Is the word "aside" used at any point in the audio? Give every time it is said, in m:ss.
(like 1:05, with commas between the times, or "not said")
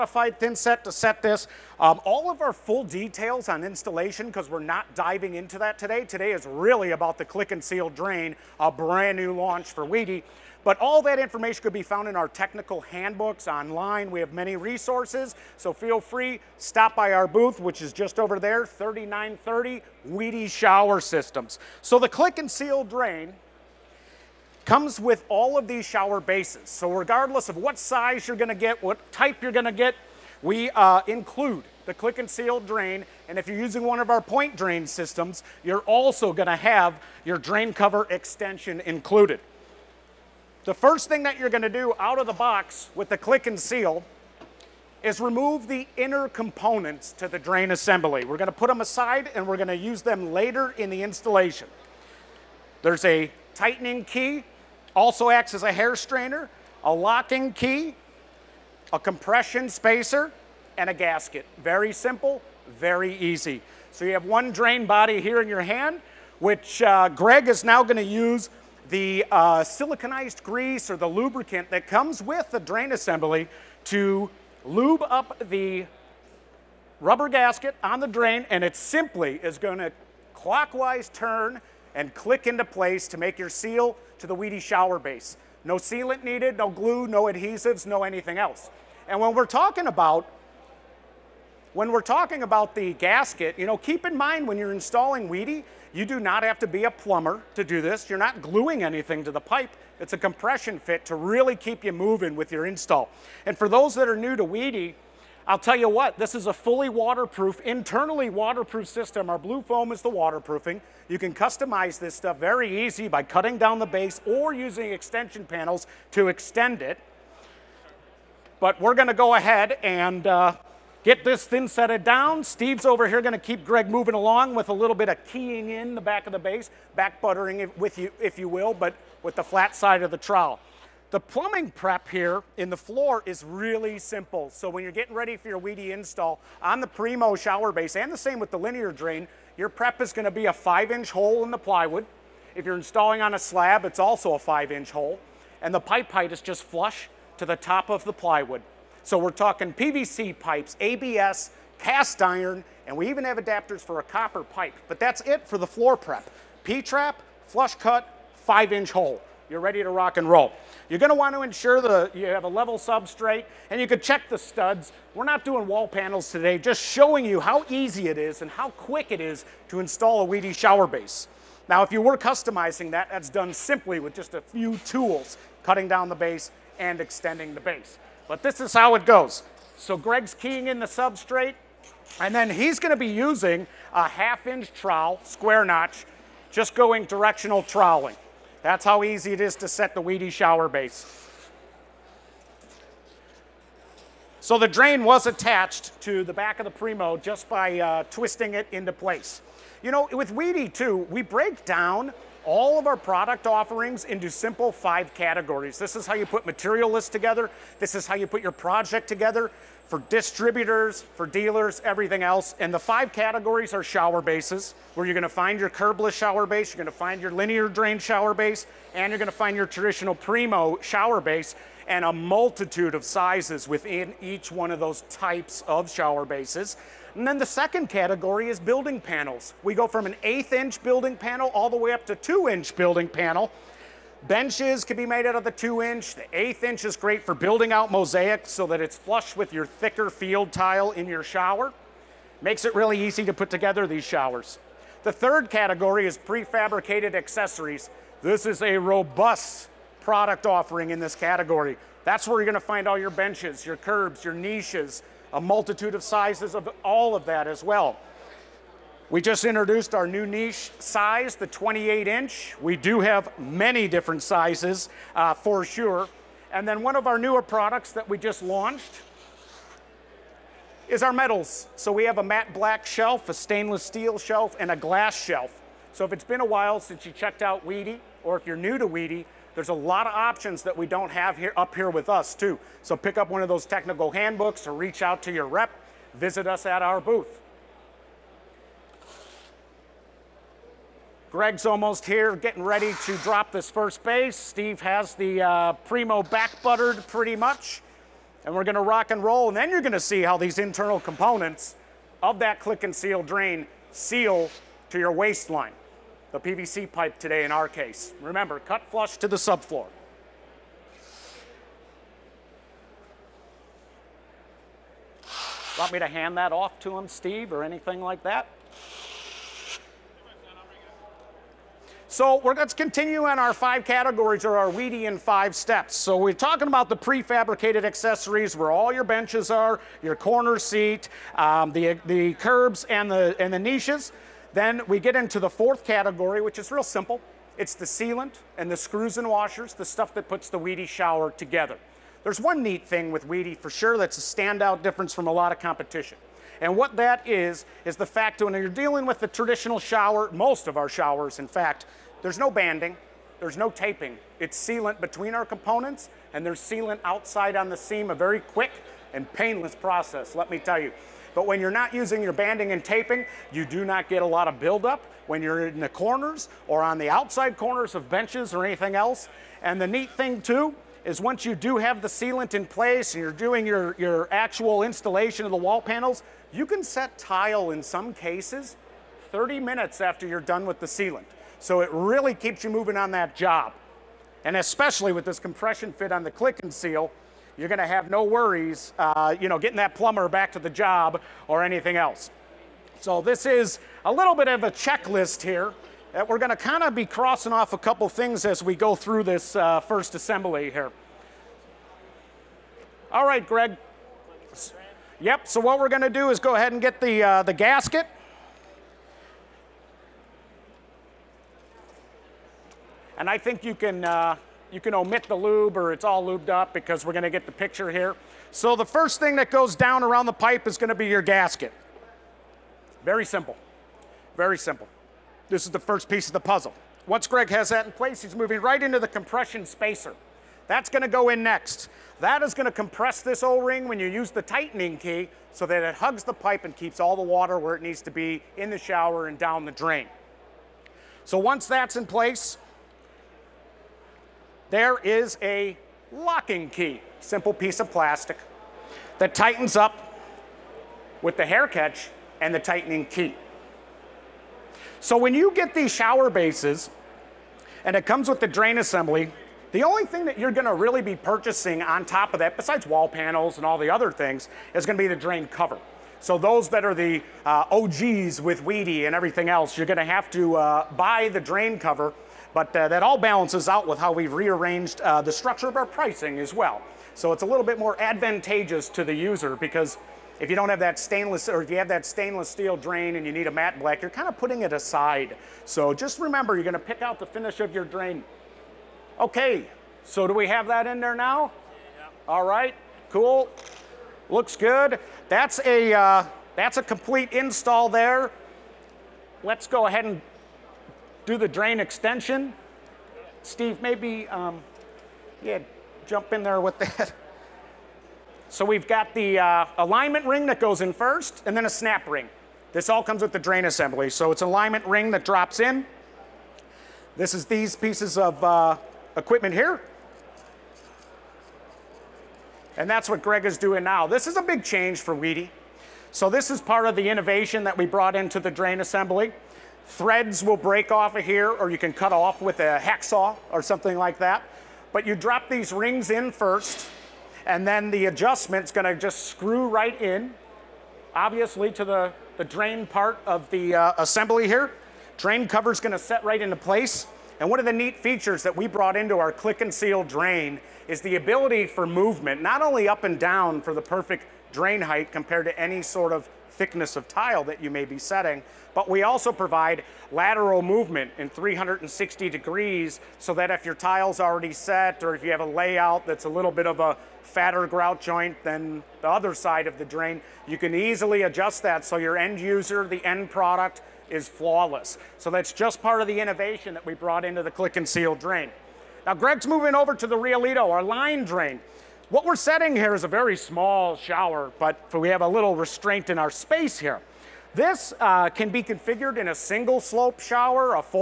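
0:48, 8:04.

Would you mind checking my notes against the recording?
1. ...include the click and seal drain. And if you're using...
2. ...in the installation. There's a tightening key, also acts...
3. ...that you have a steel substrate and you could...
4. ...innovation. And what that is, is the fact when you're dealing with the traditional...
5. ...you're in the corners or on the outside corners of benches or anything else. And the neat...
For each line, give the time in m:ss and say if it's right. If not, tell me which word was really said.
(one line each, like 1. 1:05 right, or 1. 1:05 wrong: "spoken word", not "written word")
1. 0:31 right
2. 0:50 right
3. 2:41 wrong: "level", not "steel"
4. 5:45 wrong: "competition", not "innovation"
5. 6:05 right.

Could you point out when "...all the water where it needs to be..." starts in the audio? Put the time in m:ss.
7:16.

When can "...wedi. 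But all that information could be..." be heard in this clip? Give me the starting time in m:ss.
0:09.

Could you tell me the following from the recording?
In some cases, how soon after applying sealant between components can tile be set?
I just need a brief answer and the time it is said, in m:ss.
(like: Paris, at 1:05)
30 minutes, at 6:19.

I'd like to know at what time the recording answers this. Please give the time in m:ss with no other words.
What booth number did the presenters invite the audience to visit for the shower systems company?
0:18.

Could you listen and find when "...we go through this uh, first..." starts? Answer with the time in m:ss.
6:38.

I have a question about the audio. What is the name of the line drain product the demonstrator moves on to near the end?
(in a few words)
Riolito.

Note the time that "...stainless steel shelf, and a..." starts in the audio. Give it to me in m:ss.
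4:33.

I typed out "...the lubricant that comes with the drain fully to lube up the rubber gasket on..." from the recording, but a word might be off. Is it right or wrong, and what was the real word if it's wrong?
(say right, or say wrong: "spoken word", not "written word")
wrong: "assembly", not "fully".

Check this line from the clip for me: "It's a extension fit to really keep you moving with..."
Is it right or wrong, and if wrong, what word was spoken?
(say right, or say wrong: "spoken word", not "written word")
wrong: "compression", not "extension".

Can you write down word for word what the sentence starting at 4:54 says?
Steve has the uh, Primo back buttered pretty much.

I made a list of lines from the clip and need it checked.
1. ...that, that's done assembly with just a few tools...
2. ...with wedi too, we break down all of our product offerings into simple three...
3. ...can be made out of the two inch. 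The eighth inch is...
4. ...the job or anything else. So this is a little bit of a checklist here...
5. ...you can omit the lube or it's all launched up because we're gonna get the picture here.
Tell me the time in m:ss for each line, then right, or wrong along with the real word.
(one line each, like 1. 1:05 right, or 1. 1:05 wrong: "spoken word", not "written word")
1. 2:52 wrong: "simply", not "assembly"
2. 3:20 wrong: "five", not "three"
3. 3:54 right
4. 6:30 right
5. 6:54 wrong: "lubed", not "launched".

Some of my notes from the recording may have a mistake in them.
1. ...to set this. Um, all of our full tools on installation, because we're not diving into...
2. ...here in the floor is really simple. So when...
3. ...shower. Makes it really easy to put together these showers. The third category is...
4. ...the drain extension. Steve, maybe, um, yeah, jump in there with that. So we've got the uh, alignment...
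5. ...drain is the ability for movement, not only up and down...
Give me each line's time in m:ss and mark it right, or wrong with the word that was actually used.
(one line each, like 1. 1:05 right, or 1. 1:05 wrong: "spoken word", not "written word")
1. 0:00 wrong: "details", not "tools"
2. 2:12 right
3. 4:01 right
4. 8:21 right
5. 9:10 right.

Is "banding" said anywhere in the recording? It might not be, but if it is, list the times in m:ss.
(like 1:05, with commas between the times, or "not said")
5:52, 6:02.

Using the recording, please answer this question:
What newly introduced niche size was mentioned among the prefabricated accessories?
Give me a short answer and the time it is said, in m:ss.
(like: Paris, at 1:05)
28 inch, at 4:21.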